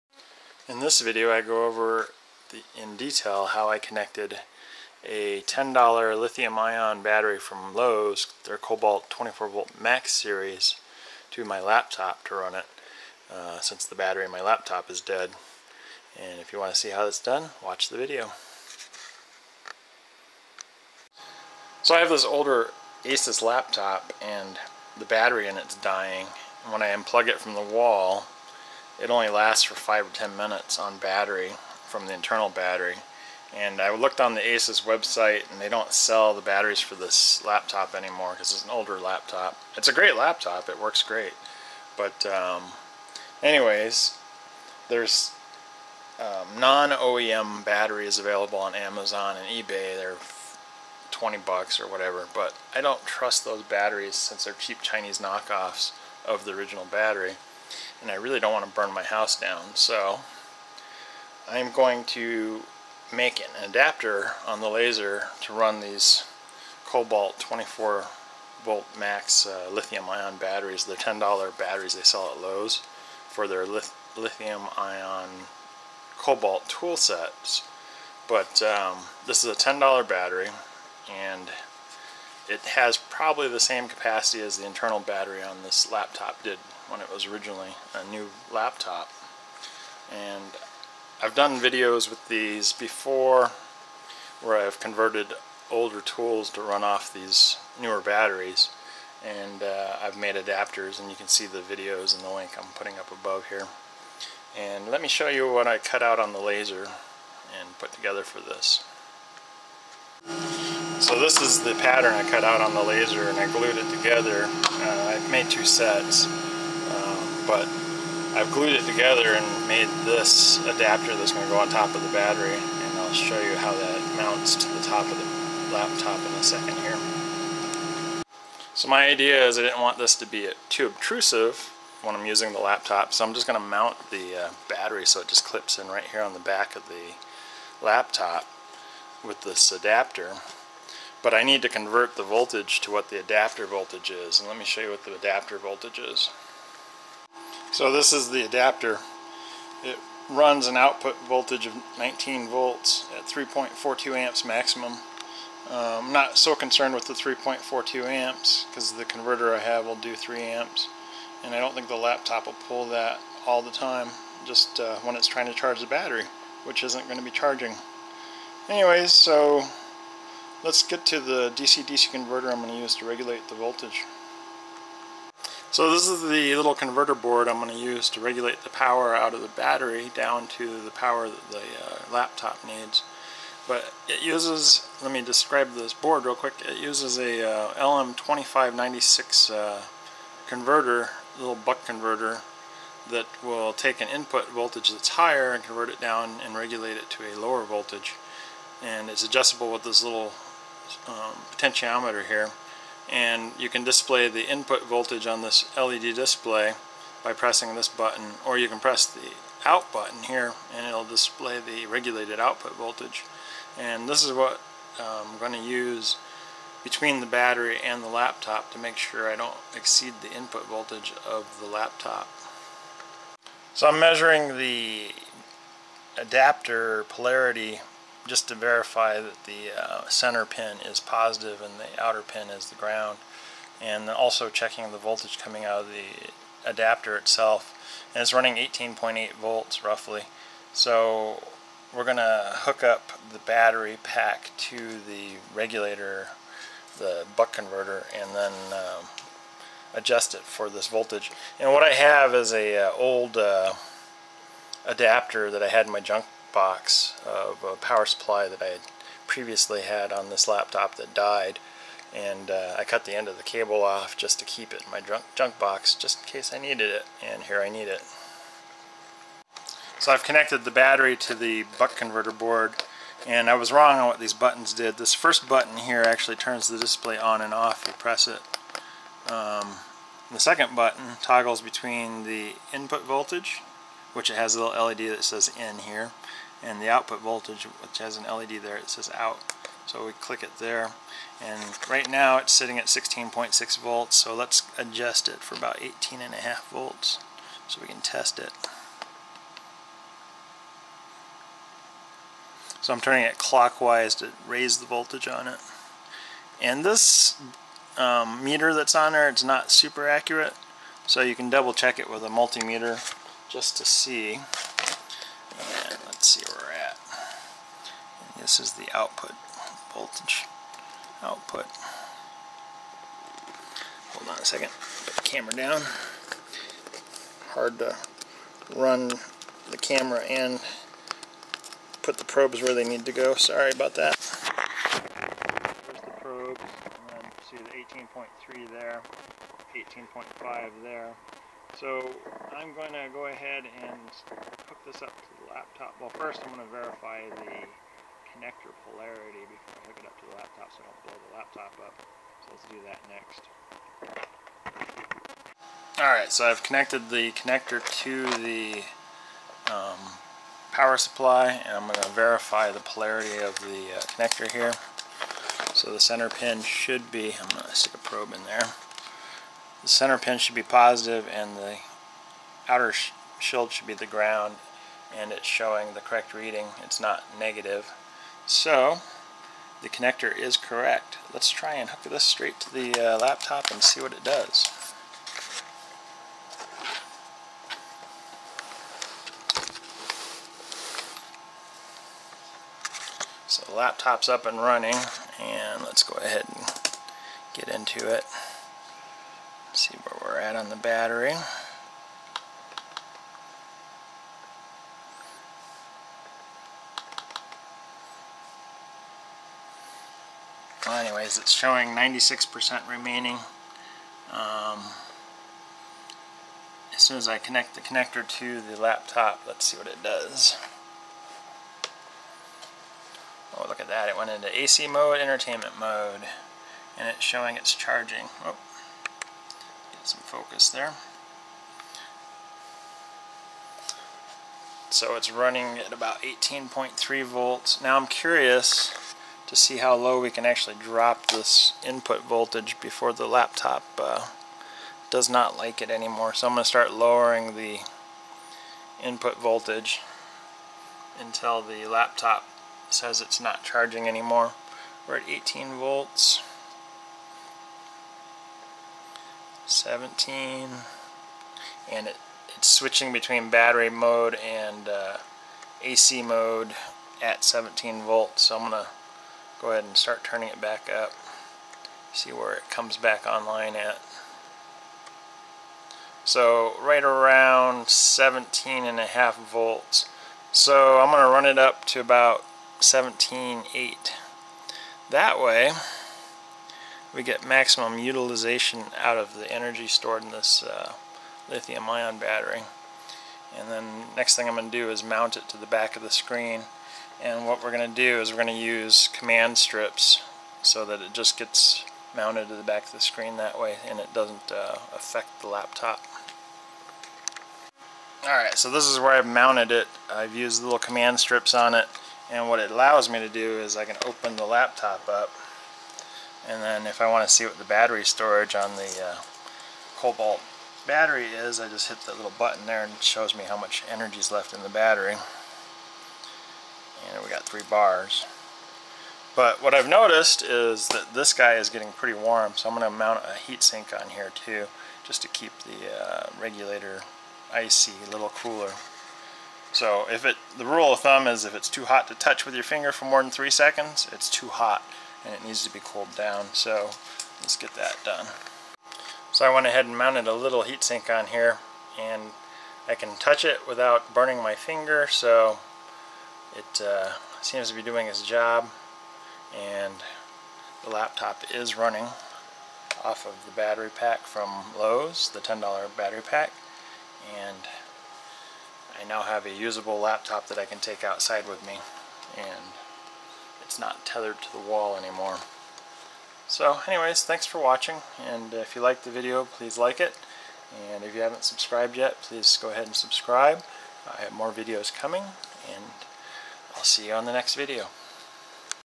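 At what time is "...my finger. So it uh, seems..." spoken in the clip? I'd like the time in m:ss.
9:14.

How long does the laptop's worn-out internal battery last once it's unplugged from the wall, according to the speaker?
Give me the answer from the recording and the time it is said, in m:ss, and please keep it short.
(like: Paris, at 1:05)
5 or 10 minutes, at 0:29.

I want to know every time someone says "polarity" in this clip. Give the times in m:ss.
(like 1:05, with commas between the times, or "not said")
3:47, 5:48, 6:02.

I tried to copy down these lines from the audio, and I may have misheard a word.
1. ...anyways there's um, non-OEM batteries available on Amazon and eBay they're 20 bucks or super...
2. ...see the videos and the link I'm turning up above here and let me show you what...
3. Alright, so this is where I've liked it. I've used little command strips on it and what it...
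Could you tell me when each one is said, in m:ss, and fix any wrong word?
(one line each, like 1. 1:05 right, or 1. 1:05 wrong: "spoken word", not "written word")
1. 0:43 wrong: "whatever", not "super"
2. 1:41 wrong: "putting", not "turning"
3. 8:28 wrong: "mounted", not "liked".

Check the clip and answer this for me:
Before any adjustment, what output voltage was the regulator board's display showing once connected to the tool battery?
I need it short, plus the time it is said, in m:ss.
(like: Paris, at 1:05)
16.6 volts, at 4:52.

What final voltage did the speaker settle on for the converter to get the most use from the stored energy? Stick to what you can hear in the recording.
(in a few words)
17.8 volts.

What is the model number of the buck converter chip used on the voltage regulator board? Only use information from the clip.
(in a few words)
LM2596.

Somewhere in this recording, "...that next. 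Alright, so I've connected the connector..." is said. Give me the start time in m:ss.
5:52.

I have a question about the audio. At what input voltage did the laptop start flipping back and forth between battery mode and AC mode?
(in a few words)
17 volts.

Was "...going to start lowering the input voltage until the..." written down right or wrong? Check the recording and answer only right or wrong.
right.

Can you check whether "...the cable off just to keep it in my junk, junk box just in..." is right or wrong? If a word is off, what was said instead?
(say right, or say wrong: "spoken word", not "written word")
right.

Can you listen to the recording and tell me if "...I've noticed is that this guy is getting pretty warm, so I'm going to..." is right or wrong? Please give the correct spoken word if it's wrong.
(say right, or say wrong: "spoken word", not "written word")
right.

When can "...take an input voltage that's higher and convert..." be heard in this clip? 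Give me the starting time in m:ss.
3:13.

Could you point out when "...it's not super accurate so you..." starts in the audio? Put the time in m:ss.
5:09.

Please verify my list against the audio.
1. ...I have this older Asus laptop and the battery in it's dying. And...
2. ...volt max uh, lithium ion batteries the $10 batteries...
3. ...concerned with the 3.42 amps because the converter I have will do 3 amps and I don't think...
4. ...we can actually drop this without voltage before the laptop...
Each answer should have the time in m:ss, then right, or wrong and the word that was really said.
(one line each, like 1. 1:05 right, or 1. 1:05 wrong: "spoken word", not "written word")
1. 0:21 right
2. 1:08 right
3. 2:36 right
4. 7:20 wrong: "input", not "without".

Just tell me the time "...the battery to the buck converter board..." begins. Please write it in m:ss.
4:30.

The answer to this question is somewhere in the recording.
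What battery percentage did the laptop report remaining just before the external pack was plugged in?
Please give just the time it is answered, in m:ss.
6:51.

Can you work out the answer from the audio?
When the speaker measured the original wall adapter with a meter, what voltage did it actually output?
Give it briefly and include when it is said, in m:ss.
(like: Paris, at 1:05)
18.8 volts, at 3:58.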